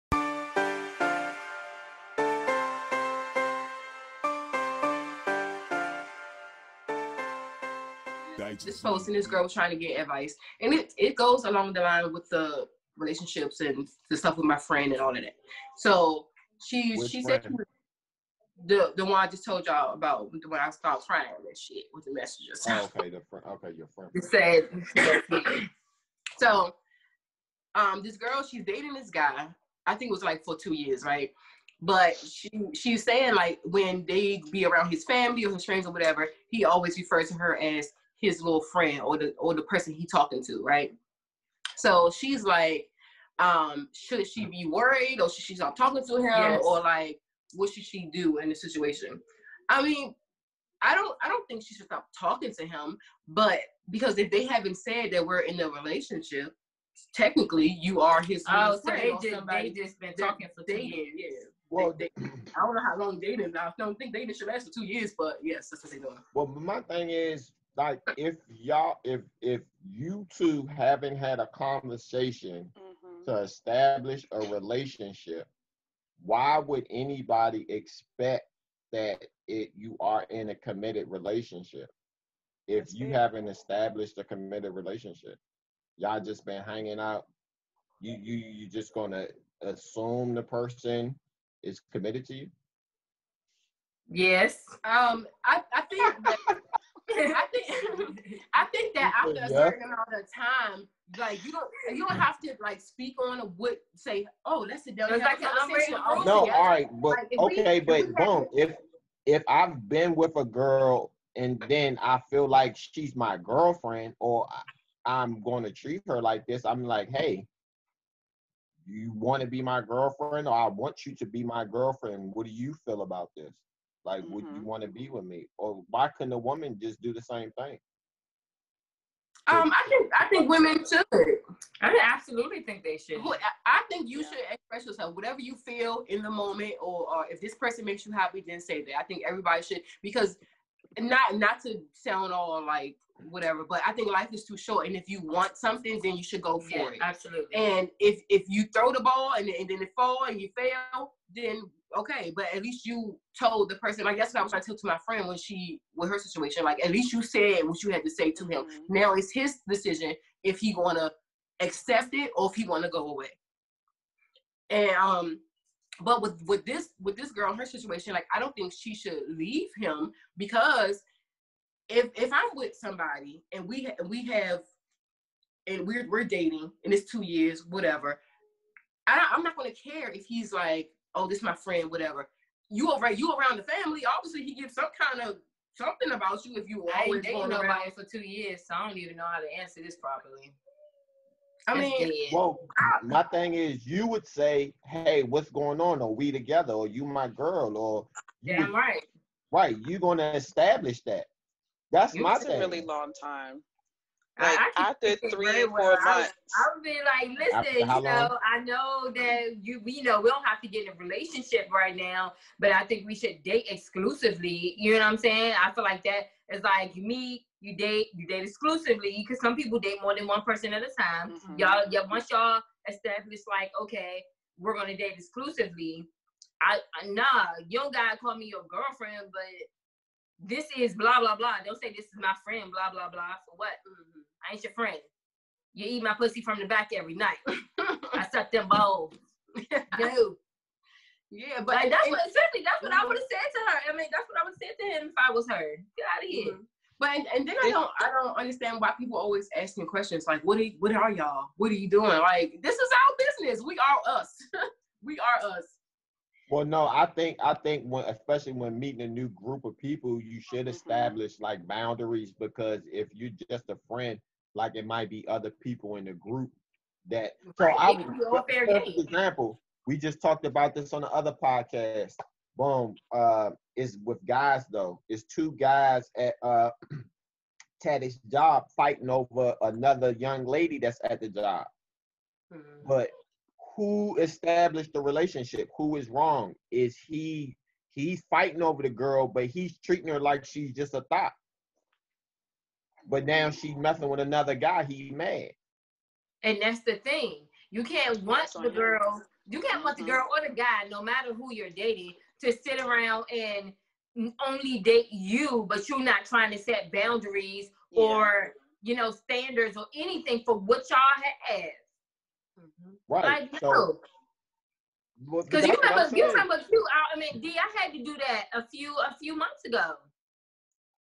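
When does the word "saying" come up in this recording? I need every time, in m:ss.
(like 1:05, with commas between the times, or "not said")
0:33, 3:35.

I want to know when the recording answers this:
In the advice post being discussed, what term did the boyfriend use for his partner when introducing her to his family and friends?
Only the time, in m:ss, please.
0:38.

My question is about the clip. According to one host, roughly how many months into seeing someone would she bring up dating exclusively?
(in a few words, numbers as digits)
3 or 4 months.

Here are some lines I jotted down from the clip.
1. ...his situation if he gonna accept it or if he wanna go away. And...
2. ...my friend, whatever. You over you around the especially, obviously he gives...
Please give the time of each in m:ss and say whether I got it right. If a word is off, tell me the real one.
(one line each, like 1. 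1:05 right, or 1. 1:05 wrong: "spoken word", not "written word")
1. 2:39 wrong: "decision", not "situation"
2. 3:01 wrong: "family", not "especially".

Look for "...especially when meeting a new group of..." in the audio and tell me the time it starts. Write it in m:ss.
4:18.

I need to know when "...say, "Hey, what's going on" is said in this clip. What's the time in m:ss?
3:14.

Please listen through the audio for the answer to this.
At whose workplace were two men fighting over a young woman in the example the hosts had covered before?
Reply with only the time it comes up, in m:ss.
4:37.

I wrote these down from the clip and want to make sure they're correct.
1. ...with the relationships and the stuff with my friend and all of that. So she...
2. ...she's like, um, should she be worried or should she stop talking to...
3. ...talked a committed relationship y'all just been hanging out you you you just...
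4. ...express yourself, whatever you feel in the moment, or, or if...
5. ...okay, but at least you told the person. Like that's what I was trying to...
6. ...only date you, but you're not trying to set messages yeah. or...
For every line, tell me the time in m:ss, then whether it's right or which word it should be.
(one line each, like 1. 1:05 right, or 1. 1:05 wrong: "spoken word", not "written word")
1. 0:12 right
2. 0:42 right
3. 1:23 wrong: "established", not "talked"
4. 2:14 right
5. 2:31 right
6. 5:04 wrong: "boundaries", not "messages".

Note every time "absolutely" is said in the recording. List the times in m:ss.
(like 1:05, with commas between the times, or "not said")
2:12, 2:27.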